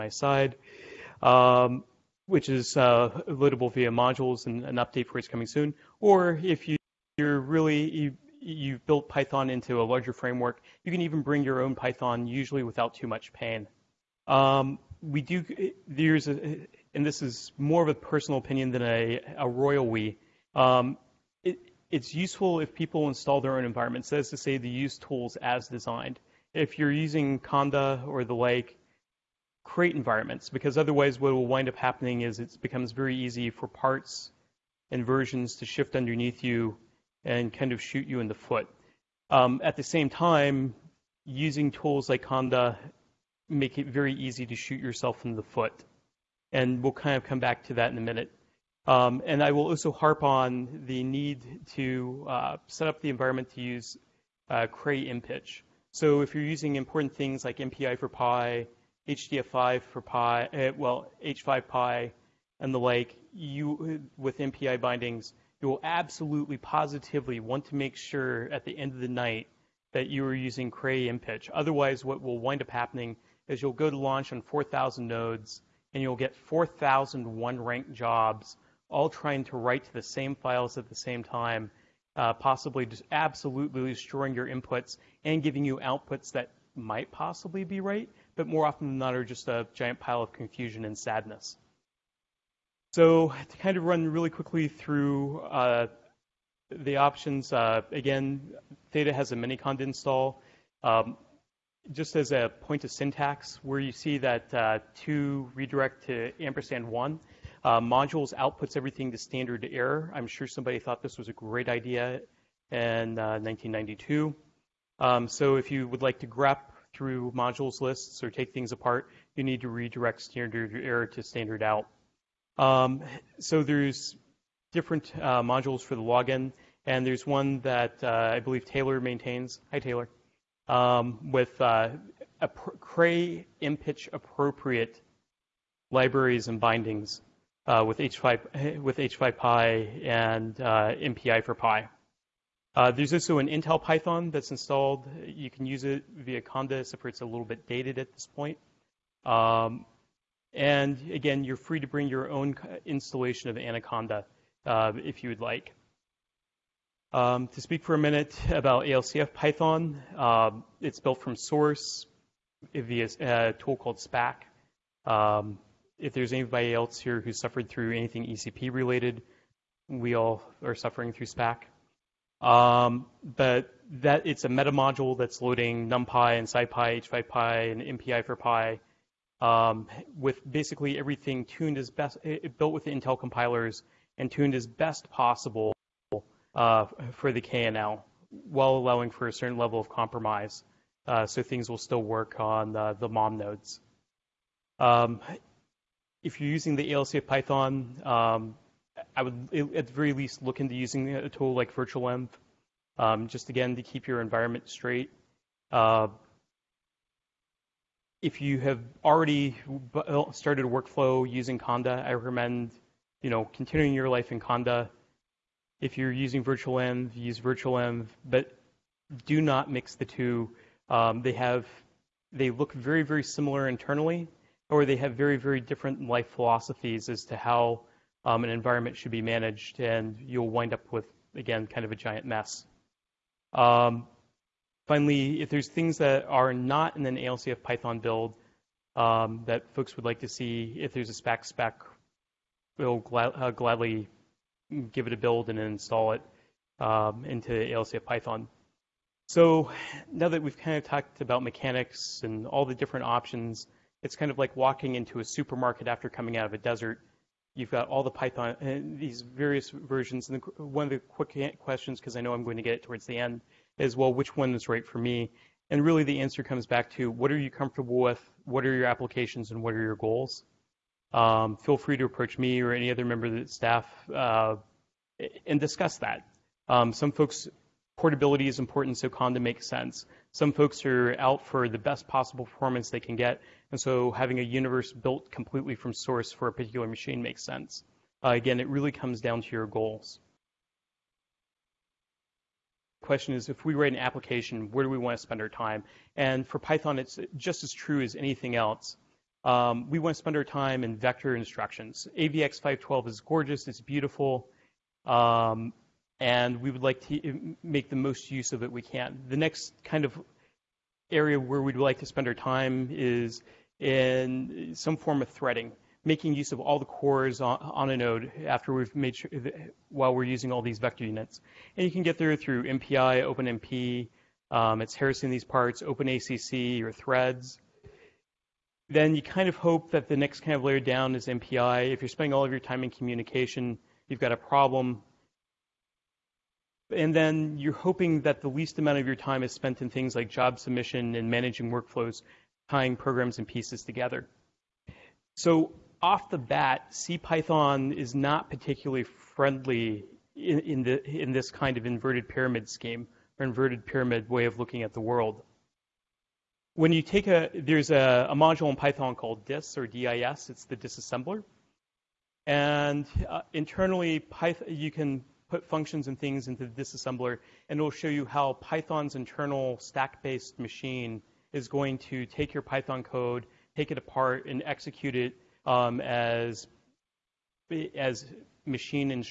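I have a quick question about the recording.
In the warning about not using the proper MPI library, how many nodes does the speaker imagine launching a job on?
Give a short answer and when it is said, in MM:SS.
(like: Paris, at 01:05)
4,000, at 01:14.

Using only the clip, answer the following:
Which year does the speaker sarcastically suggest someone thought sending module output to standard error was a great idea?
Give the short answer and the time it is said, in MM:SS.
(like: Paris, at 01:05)
1992, at 01:53.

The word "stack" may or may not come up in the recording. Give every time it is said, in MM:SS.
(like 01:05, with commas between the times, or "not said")
06:09.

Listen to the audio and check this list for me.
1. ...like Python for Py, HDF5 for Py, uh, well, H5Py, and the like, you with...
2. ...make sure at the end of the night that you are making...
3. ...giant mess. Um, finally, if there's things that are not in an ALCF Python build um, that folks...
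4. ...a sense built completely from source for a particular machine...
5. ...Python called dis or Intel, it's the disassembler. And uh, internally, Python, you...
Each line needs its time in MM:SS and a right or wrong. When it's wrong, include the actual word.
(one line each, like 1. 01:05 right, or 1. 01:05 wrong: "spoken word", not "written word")
1. 00:57 wrong: "MPI", not "Python"
2. 01:07 wrong: "using", not "making"
3. 03:51 right
4. 04:44 wrong: "universe", not "sense"
5. 05:58 wrong: "DIS", not "Intel".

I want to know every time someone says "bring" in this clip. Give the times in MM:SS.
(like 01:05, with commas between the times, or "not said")
00:11, 02:31.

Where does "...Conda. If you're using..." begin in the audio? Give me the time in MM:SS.
03:34.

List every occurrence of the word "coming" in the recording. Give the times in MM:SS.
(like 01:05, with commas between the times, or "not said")
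00:05, 04:16.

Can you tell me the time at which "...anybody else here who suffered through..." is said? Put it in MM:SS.
02:46.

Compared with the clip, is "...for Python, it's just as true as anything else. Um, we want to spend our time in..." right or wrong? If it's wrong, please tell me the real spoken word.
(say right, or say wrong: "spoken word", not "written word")
right.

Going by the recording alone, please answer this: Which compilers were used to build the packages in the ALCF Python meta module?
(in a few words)
Intel compilers.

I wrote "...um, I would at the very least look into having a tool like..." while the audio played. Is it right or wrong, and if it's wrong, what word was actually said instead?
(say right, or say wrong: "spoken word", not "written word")
wrong: "using", not "having".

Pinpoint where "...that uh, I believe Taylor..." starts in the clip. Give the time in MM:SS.
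02:07.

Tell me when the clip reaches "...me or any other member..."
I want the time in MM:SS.
04:32.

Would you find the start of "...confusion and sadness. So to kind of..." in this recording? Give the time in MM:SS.
01:30.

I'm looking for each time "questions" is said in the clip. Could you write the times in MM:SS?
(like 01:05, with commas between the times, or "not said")
04:21, 04:53.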